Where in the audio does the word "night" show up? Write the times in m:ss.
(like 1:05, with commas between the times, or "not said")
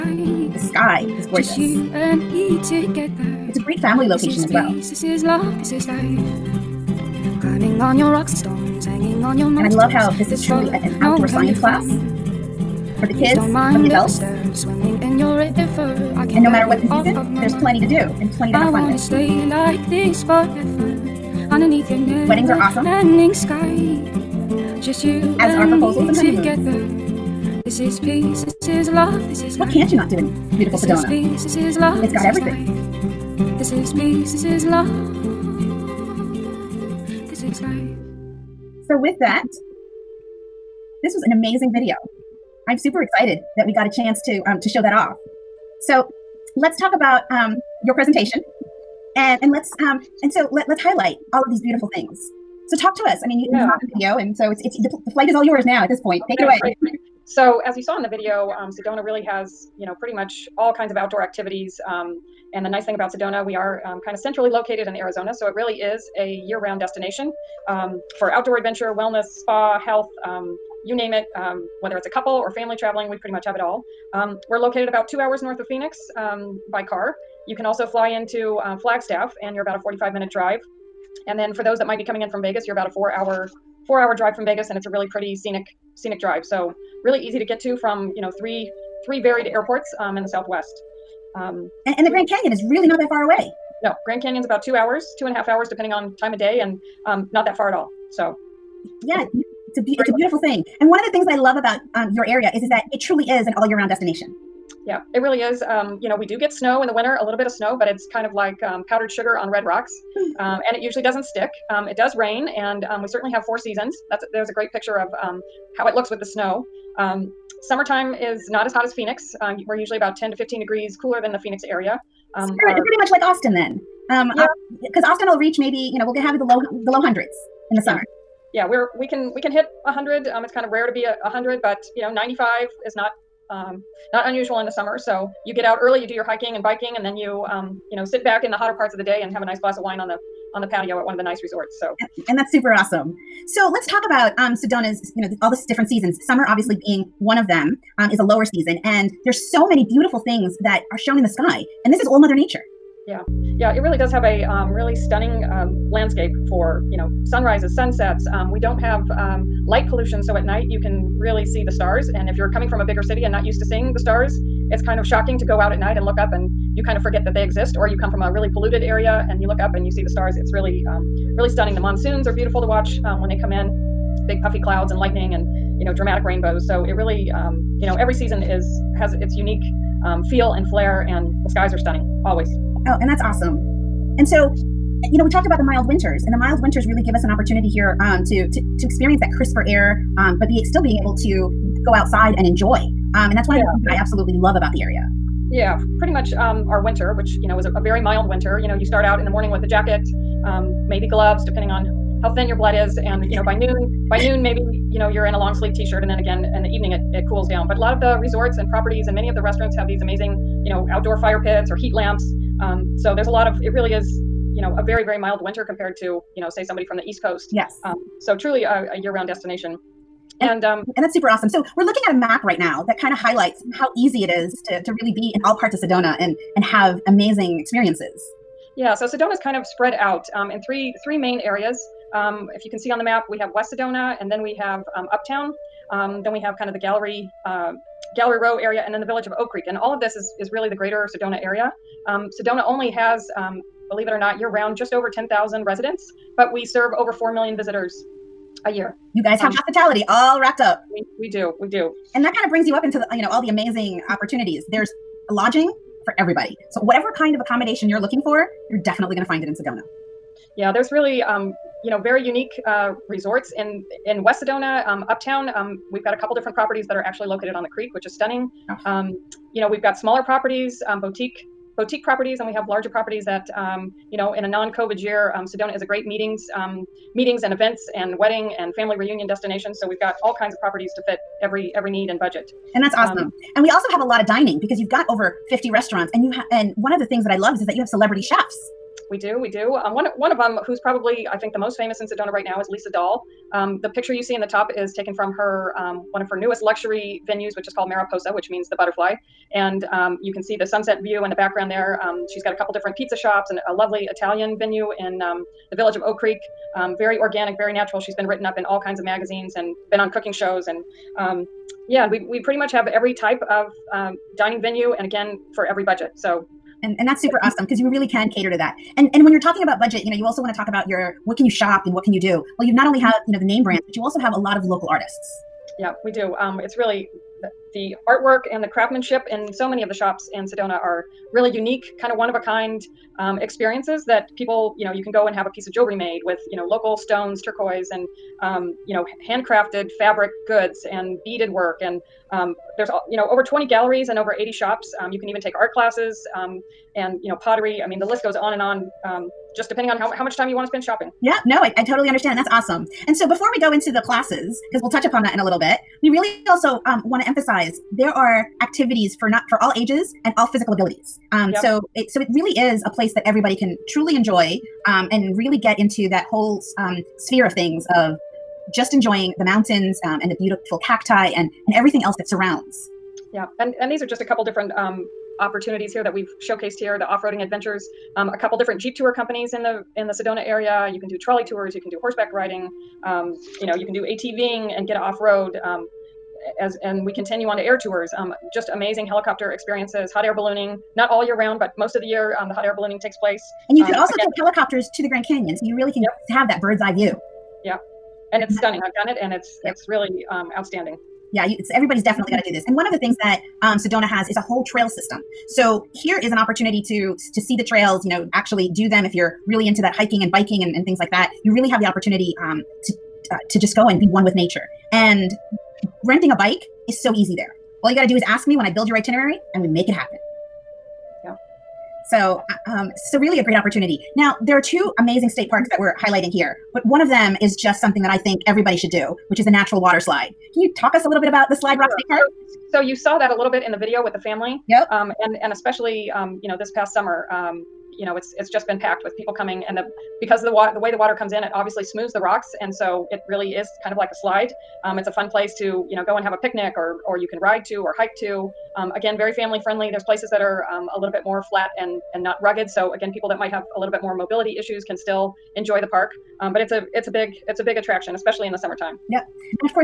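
2:40, 2:45.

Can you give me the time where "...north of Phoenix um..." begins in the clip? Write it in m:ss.
1:15.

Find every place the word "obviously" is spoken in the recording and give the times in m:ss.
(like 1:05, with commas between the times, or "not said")
2:26, 7:21.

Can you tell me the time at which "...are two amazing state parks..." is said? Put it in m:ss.
7:04.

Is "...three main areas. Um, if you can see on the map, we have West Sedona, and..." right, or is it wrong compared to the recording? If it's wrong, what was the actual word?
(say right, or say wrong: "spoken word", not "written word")
right.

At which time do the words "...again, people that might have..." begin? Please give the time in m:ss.
7:32.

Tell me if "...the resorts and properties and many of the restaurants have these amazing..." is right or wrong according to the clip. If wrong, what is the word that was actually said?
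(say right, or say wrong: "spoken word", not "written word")
right.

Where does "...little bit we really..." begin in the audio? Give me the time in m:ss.
5:55.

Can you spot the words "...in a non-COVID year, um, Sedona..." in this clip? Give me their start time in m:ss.
4:34.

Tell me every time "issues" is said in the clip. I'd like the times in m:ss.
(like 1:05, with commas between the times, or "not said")
7:34.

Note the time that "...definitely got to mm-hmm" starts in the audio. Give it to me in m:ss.
6:42.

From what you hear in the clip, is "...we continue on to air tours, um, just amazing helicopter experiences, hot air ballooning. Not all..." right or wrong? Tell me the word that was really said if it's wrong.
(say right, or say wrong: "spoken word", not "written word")
right.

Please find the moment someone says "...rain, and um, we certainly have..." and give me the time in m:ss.
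1:52.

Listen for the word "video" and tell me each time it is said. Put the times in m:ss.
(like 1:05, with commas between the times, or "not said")
0:41, 0:53, 0:58, 7:13.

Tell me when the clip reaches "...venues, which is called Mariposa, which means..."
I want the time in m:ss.
4:57.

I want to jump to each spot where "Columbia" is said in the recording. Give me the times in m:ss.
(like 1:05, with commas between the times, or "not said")
not said.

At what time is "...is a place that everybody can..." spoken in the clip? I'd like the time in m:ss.
6:02.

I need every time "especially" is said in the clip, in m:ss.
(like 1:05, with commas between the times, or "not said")
7:15, 7:38.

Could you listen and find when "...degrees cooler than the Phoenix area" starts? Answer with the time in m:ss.
2:00.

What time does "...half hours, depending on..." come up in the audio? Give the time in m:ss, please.
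1:35.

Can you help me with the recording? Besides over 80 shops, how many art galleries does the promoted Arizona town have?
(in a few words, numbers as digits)
over 20.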